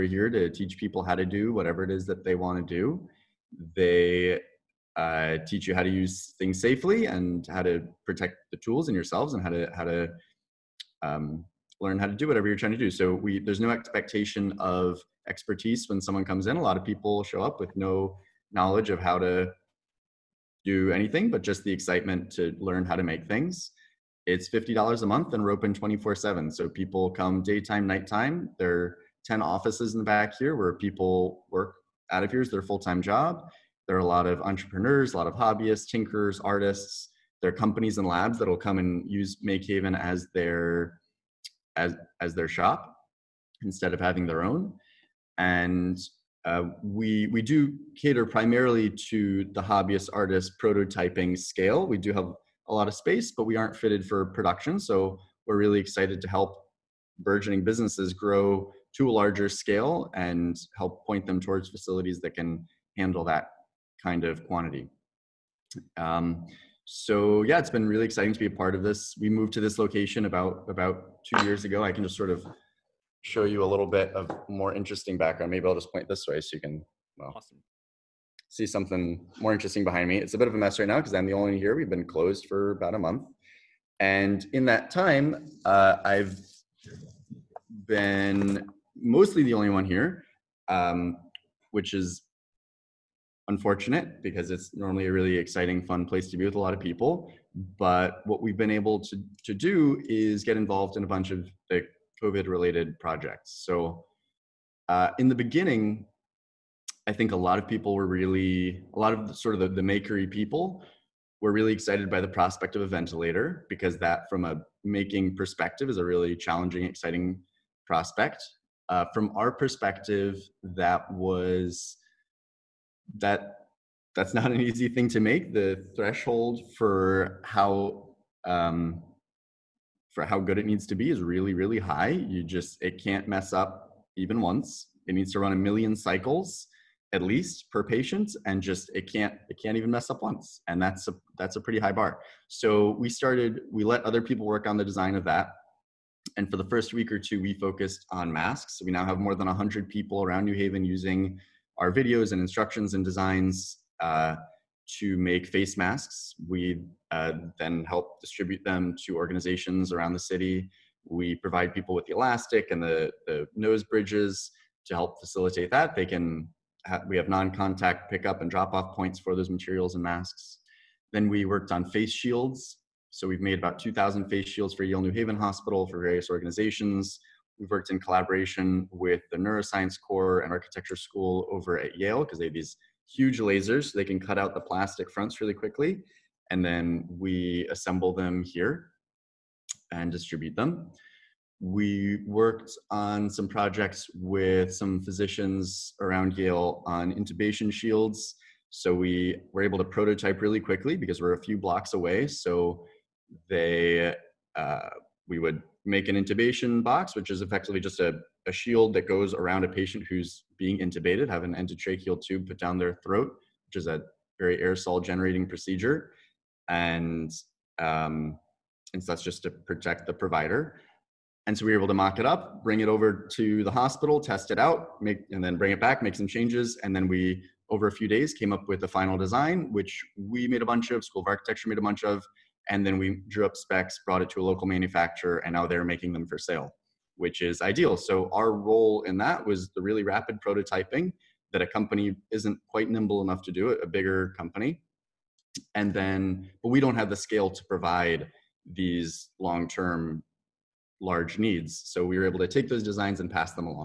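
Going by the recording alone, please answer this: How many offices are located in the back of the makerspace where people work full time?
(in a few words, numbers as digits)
10.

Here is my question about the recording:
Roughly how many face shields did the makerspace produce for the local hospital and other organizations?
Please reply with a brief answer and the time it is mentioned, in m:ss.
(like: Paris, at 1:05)
2,000, at 2:53.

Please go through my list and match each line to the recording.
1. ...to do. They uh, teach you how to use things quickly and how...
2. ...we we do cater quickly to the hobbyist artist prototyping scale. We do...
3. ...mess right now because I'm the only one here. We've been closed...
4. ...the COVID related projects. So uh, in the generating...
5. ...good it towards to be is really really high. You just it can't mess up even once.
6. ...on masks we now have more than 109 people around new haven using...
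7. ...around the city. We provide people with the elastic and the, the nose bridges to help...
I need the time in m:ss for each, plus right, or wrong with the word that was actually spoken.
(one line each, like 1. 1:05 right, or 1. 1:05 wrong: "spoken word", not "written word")
1. 0:02 wrong: "safely", not "quickly"
2. 0:46 wrong: "primarily", not "quickly"
3. 1:20 right
4. 1:41 wrong: "beginning", not "generating"
5. 2:10 wrong: "needs", not "towards"
6. 2:28 wrong: "100", not "109"
7. 2:39 right.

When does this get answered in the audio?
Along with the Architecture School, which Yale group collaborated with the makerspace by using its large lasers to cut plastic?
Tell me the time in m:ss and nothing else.
2:59.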